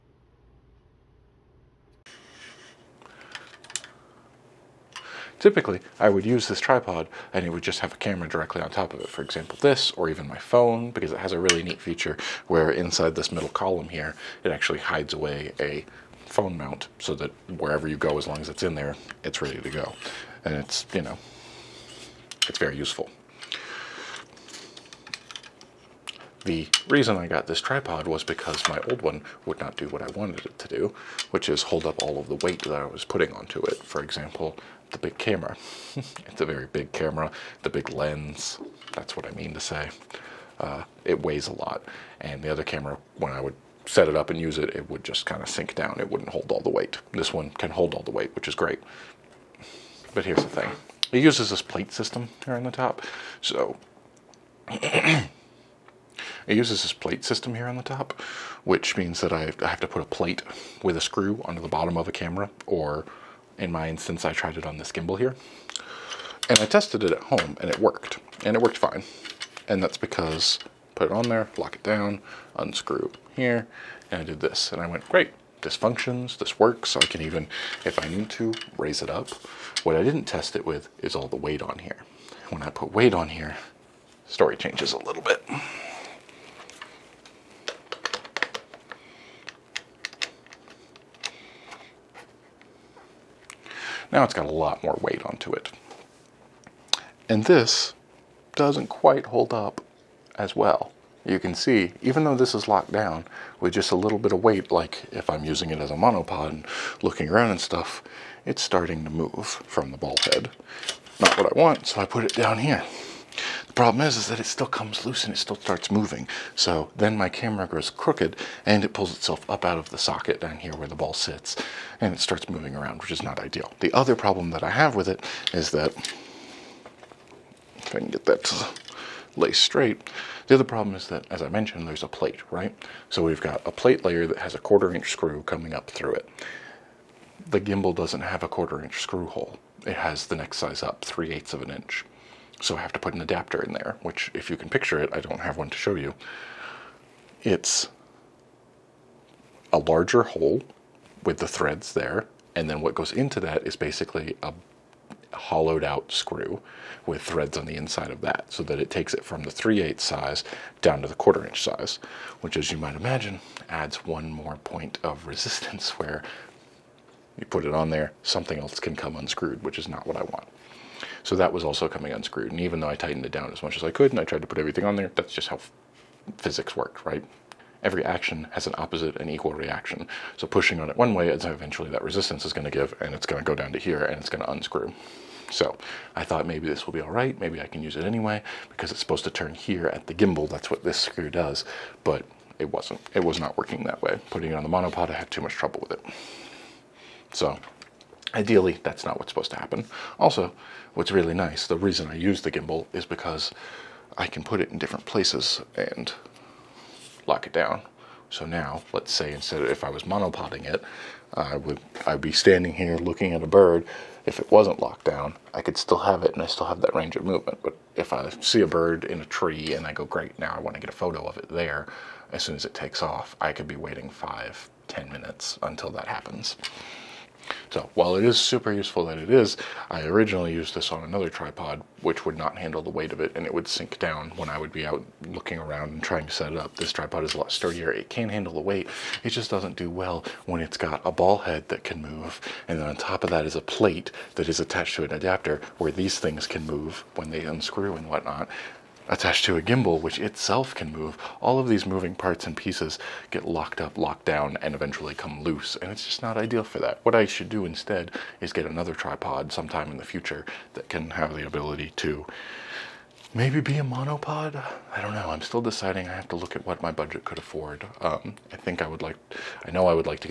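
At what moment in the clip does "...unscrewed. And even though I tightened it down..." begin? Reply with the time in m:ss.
2:52.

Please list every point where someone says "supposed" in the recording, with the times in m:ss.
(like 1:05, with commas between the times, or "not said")
3:09, 3:19.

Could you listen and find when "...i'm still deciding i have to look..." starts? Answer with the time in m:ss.
4:25.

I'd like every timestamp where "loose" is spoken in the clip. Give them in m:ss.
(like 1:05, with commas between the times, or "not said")
1:55, 4:15.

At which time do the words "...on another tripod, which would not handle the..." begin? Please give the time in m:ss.
3:50.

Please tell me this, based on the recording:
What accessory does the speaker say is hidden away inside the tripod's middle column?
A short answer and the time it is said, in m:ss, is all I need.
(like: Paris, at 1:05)
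phone mount, at 0:16.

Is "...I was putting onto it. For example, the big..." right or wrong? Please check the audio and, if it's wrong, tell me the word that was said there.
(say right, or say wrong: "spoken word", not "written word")
right.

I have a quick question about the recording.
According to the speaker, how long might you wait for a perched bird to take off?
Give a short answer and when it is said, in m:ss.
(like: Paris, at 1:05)
5 to 10 minutes, at 3:44.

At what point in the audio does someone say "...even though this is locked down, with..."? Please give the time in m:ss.
1:42.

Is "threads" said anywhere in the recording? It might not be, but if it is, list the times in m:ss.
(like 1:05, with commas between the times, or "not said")
2:31, 2:37.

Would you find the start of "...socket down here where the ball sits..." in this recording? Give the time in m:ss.
1:59.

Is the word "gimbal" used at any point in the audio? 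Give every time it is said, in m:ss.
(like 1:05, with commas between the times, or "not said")
1:04, 2:17, 3:10, 3:22, 4:09.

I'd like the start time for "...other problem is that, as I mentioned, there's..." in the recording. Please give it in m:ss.
2:10.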